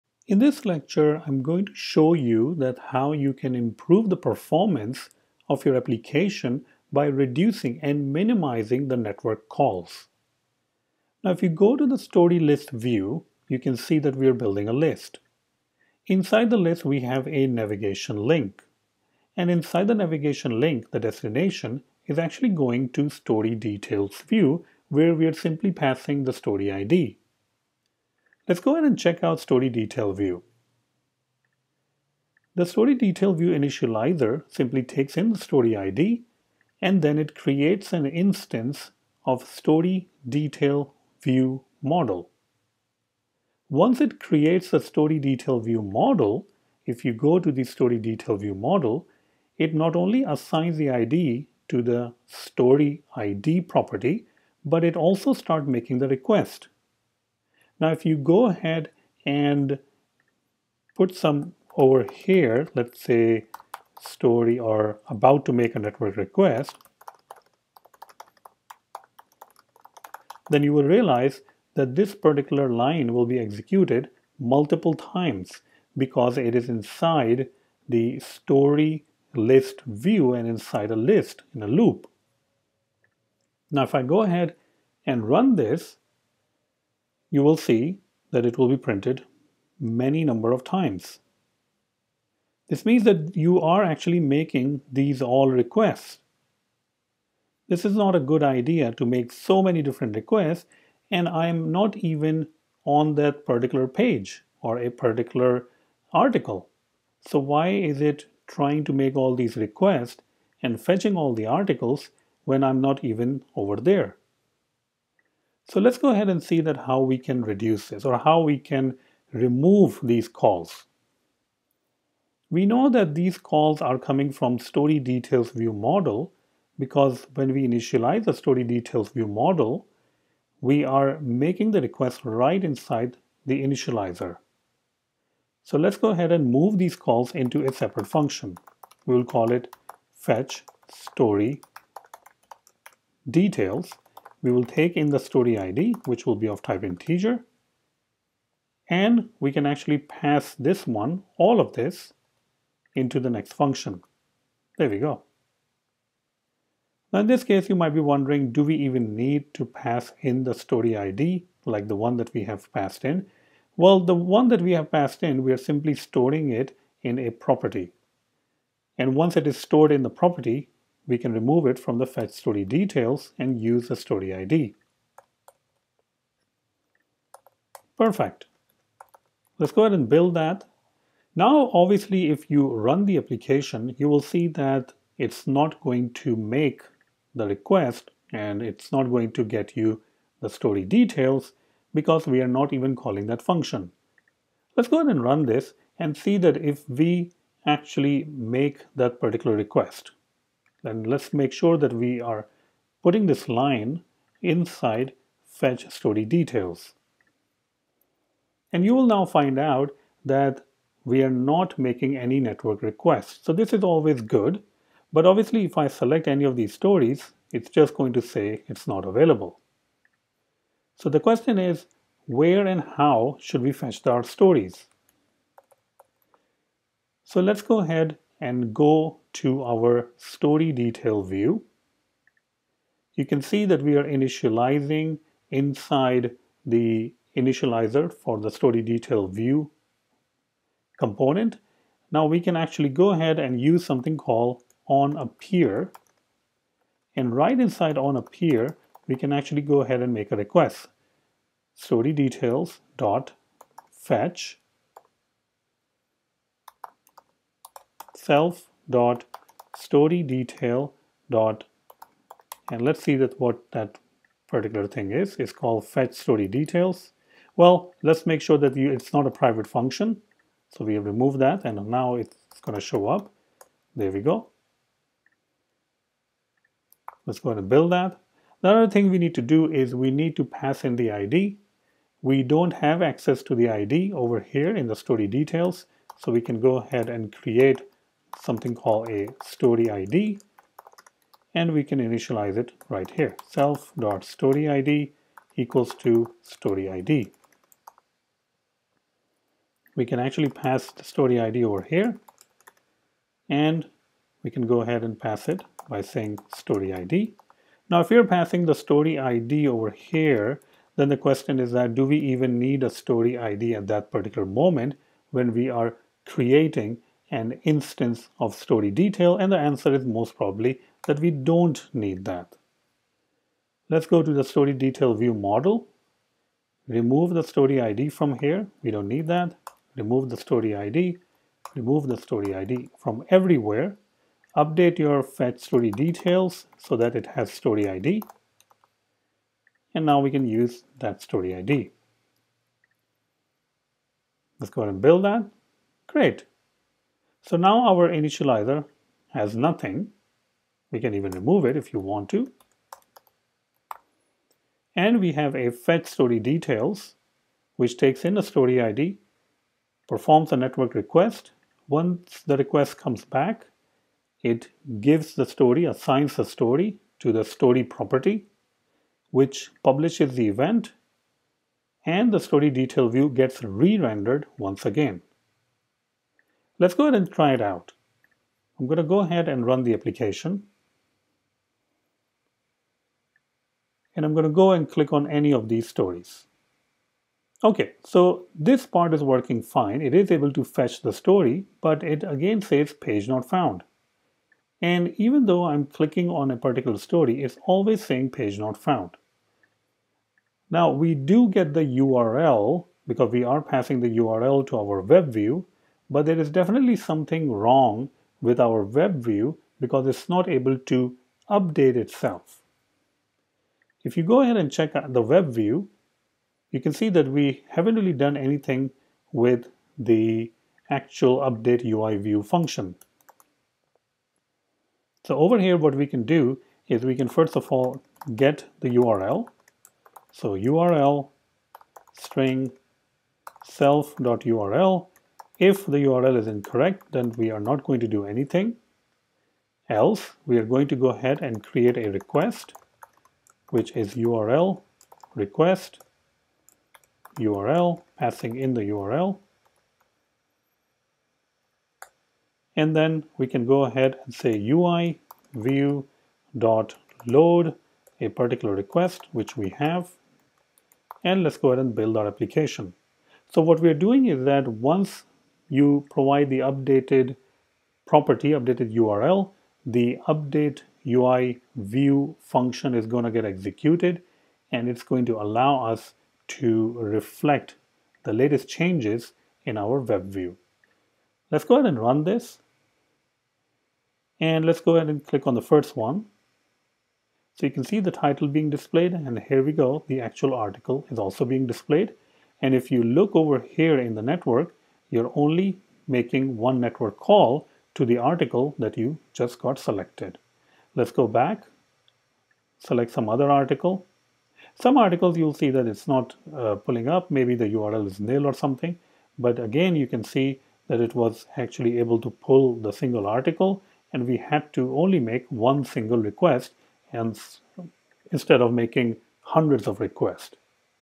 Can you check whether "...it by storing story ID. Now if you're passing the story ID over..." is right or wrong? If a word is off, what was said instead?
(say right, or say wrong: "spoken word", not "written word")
wrong: "saying", not "storing".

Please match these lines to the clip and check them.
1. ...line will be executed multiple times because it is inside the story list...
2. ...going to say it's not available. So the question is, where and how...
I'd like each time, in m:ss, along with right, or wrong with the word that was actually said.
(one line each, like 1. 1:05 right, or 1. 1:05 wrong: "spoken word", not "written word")
1. 1:12 right
2. 3:37 right.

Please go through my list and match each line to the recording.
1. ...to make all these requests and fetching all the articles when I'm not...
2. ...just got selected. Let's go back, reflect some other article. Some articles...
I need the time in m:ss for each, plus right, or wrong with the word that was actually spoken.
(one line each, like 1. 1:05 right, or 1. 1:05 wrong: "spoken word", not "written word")
1. 1:48 right
2. 8:19 wrong: "select", not "reflect".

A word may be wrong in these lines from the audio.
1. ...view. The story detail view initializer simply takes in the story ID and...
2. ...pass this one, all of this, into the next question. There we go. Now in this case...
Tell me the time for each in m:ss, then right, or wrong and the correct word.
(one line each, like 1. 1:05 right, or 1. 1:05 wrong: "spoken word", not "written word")
1. 0:30 right
2. 2:29 wrong: "function", not "question".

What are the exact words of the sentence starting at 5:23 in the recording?
Let's go to the story detail view model.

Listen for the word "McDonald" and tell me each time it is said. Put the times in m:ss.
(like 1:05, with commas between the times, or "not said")
not said.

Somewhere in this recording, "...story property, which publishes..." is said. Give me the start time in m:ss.
6:07.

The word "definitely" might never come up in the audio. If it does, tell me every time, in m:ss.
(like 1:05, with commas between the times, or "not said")
6:46.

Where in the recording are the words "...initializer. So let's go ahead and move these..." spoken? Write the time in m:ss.
2:13.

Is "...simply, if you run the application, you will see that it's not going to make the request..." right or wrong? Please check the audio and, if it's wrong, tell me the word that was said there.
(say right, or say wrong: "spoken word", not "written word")
wrong: "obviously", not "simply".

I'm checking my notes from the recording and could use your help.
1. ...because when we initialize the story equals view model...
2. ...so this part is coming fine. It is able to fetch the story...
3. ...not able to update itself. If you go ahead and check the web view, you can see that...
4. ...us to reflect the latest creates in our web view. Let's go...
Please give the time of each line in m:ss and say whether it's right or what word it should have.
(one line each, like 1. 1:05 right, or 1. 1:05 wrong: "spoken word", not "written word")
1. 2:06 wrong: "details", not "equals"
2. 6:28 wrong: "working", not "coming"
3. 6:50 right
4. 7:55 wrong: "changes", not "creates".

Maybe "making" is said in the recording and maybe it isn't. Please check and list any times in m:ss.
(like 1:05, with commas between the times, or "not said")
0:55, 1:34, 2:11, 3:31, 8:16, 8:38.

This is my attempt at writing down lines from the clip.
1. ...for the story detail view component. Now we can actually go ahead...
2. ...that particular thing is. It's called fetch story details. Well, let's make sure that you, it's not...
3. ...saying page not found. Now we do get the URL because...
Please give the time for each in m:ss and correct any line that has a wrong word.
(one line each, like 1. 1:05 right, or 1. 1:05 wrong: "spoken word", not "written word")
1. 3:58 right
2. 4:23 right
3. 6:38 right.